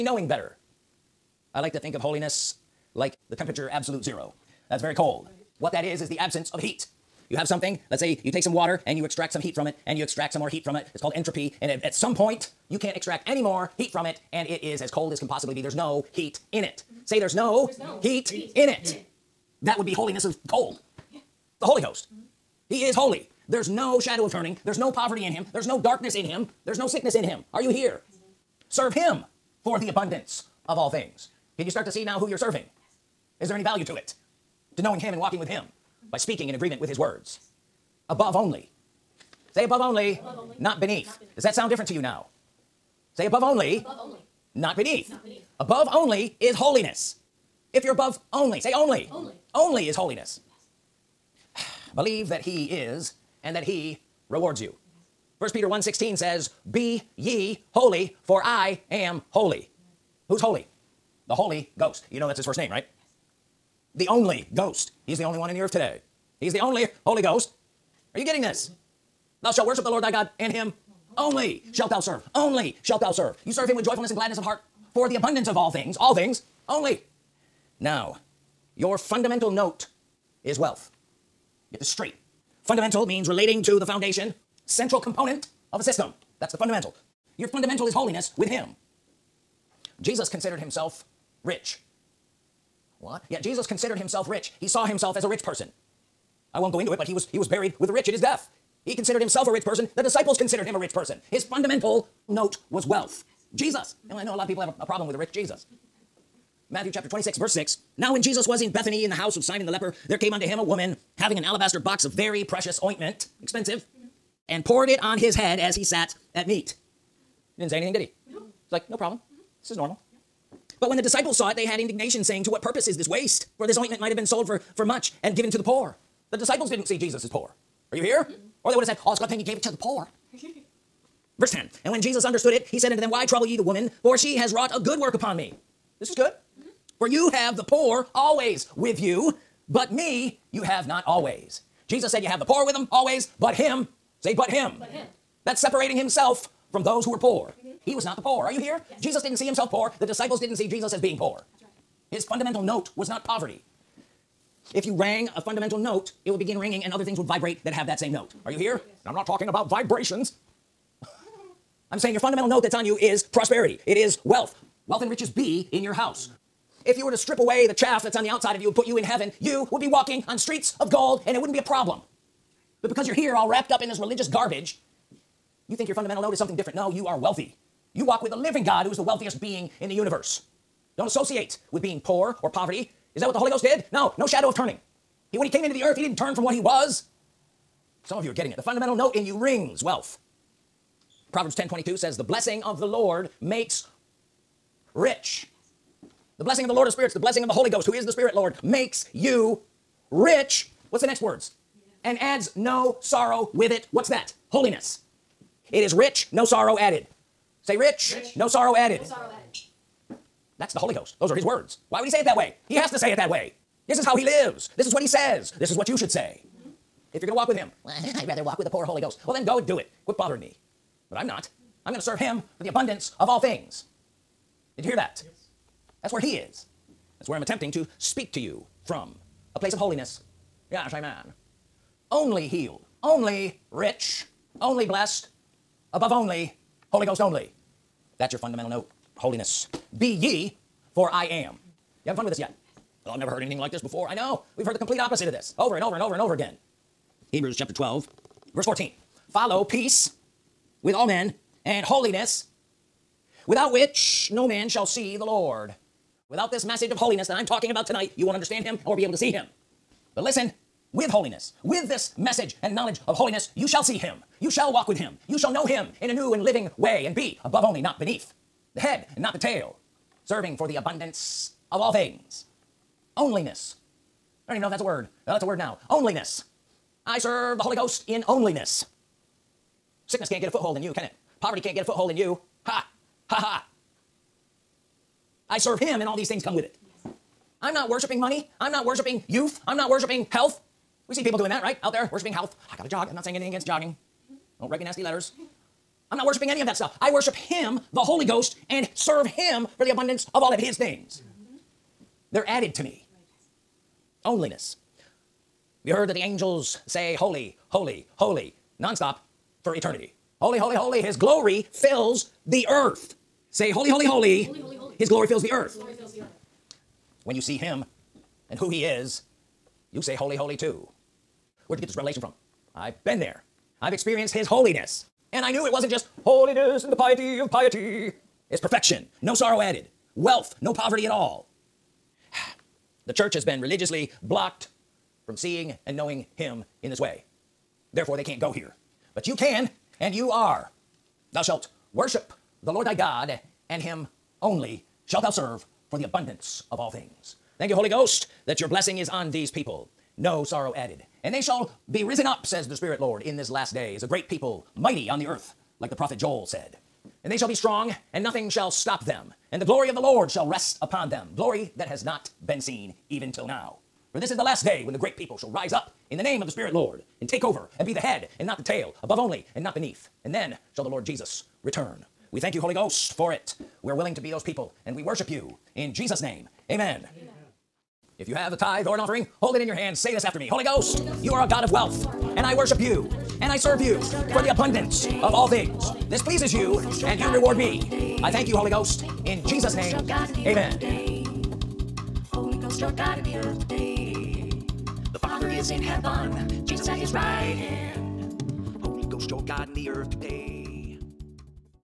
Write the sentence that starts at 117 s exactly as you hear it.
He didn't say anything, did he?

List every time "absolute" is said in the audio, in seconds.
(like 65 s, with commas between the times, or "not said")
3 s.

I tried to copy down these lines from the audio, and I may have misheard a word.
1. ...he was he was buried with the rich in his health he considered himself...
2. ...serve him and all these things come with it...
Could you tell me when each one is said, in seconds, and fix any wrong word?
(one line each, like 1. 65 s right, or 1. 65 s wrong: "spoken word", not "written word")
1. 97 s wrong: "death", not "health"
2. 285 s right.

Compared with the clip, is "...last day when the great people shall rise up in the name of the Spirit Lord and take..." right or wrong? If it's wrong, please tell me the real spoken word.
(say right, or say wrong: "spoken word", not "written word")
right.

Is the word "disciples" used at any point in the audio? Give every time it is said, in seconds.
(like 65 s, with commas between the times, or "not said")
100 s, 121 s, 126 s, 150 s.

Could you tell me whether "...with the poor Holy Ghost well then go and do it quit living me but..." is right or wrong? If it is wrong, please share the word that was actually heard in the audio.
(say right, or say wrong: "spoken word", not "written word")
wrong: "bothering", not "living".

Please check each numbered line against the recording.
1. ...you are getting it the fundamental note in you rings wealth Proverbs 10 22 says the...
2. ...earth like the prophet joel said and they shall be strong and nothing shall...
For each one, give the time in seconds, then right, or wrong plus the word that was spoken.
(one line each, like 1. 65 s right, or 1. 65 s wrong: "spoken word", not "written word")
1. 188 s right
2. 355 s right.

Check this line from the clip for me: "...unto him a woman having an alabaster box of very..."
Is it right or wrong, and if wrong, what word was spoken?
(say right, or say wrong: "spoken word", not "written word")
right.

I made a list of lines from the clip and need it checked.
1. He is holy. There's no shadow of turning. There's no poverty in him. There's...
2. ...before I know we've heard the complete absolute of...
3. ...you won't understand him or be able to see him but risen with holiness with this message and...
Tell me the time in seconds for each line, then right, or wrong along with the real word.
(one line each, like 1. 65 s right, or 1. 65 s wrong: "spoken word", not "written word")
1. 22 s right
2. 243 s wrong: "opposite", not "absolute"
3. 258 s wrong: "listen", not "risen".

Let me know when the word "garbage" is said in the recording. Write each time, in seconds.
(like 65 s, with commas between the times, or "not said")
174 s.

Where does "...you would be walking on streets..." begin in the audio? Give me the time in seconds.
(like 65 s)
169 s.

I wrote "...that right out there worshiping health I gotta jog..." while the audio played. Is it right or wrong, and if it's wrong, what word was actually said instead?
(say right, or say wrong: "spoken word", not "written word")
right.